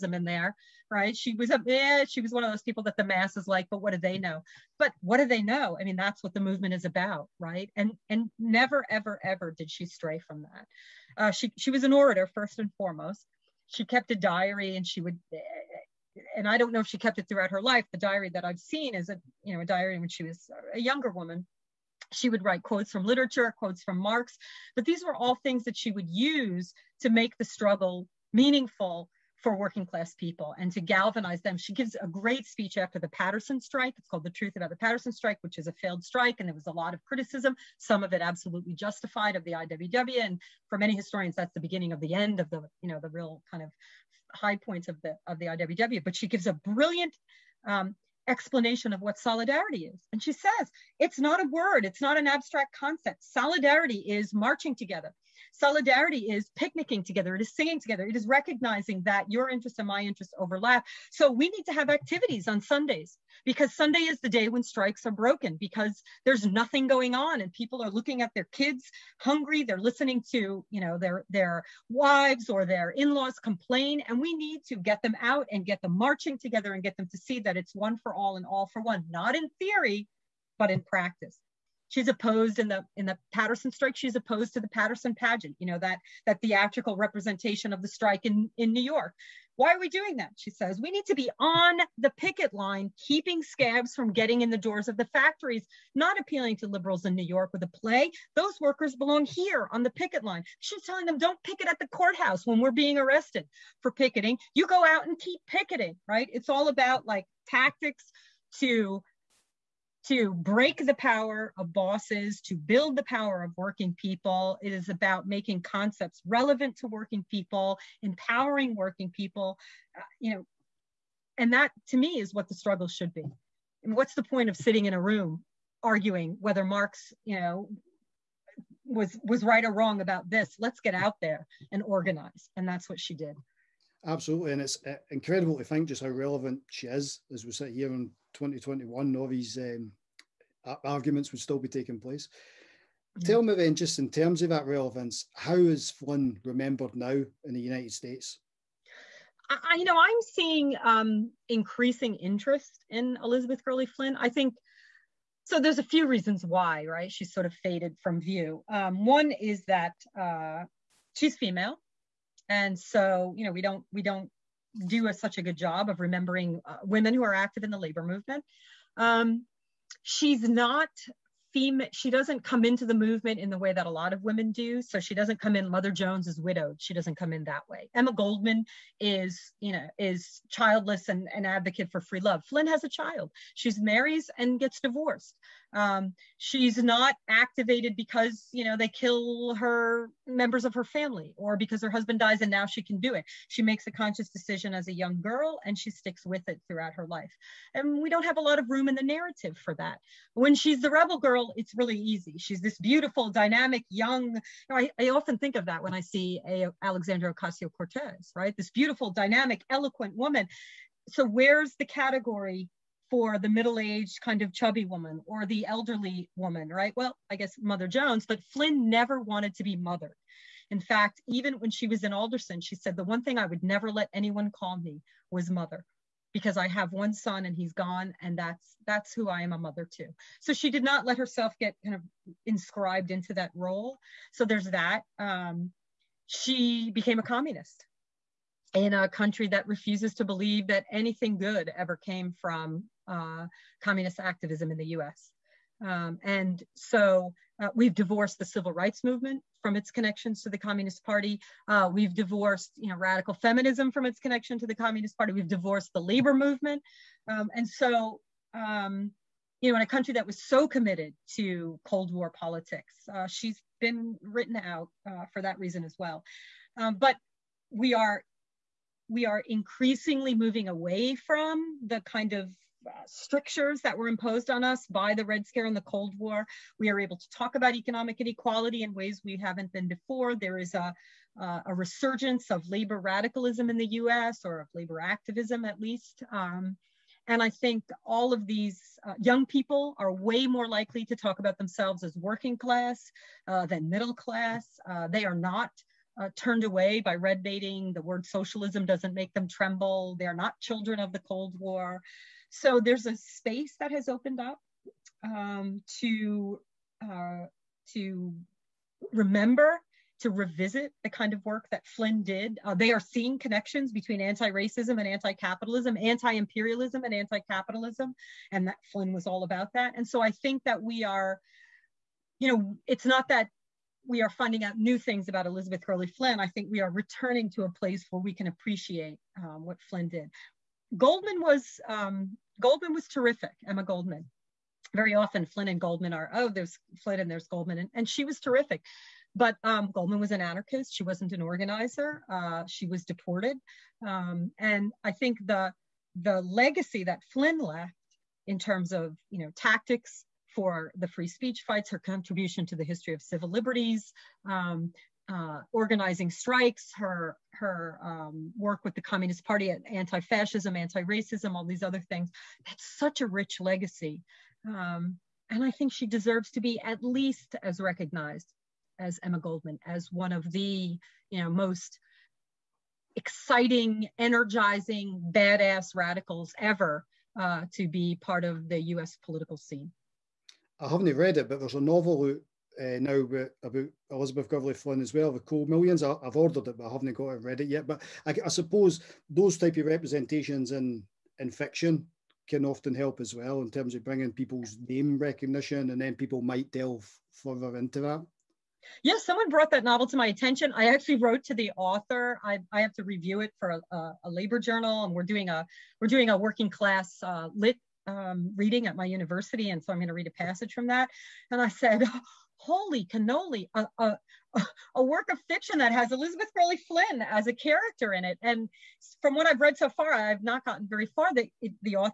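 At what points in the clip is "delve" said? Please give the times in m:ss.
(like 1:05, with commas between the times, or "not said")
6:36.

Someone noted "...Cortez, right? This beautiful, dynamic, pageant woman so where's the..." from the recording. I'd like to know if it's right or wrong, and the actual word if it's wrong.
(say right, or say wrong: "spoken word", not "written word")
wrong: "eloquent", not "pageant".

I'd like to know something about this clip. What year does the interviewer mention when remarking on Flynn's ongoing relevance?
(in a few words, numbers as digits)
2021.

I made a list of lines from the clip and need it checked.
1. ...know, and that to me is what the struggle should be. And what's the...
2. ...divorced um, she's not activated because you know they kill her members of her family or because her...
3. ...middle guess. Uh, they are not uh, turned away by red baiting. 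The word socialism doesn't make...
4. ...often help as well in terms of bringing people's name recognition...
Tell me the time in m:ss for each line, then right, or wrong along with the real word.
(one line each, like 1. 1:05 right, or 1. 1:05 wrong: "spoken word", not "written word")
1. 2:00 right
2. 3:04 right
3. 4:53 wrong: "class", not "guess"
4. 6:32 right.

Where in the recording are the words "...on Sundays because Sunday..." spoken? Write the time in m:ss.
1:02.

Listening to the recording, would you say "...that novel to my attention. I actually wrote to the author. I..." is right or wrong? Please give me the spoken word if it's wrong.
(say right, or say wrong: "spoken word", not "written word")
right.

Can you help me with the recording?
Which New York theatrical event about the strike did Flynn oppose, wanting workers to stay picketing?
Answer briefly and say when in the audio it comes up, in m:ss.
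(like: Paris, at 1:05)
The Paterson pageant, at 1:24.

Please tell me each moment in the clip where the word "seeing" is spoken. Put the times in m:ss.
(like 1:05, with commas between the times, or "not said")
2:30, 5:12.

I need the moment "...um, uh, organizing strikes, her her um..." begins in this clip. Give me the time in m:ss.
5:54.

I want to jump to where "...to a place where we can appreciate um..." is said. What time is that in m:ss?
5:27.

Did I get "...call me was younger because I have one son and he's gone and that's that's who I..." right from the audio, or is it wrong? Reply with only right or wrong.
wrong.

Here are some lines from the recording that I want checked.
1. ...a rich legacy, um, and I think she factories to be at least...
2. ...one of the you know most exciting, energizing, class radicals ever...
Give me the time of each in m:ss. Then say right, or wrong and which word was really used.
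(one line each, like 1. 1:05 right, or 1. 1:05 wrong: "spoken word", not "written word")
1. 6:03 wrong: "deserves", not "factories"
2. 6:10 wrong: "badass", not "class".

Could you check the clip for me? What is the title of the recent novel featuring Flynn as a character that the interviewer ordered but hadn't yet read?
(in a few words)
The Cold Millions.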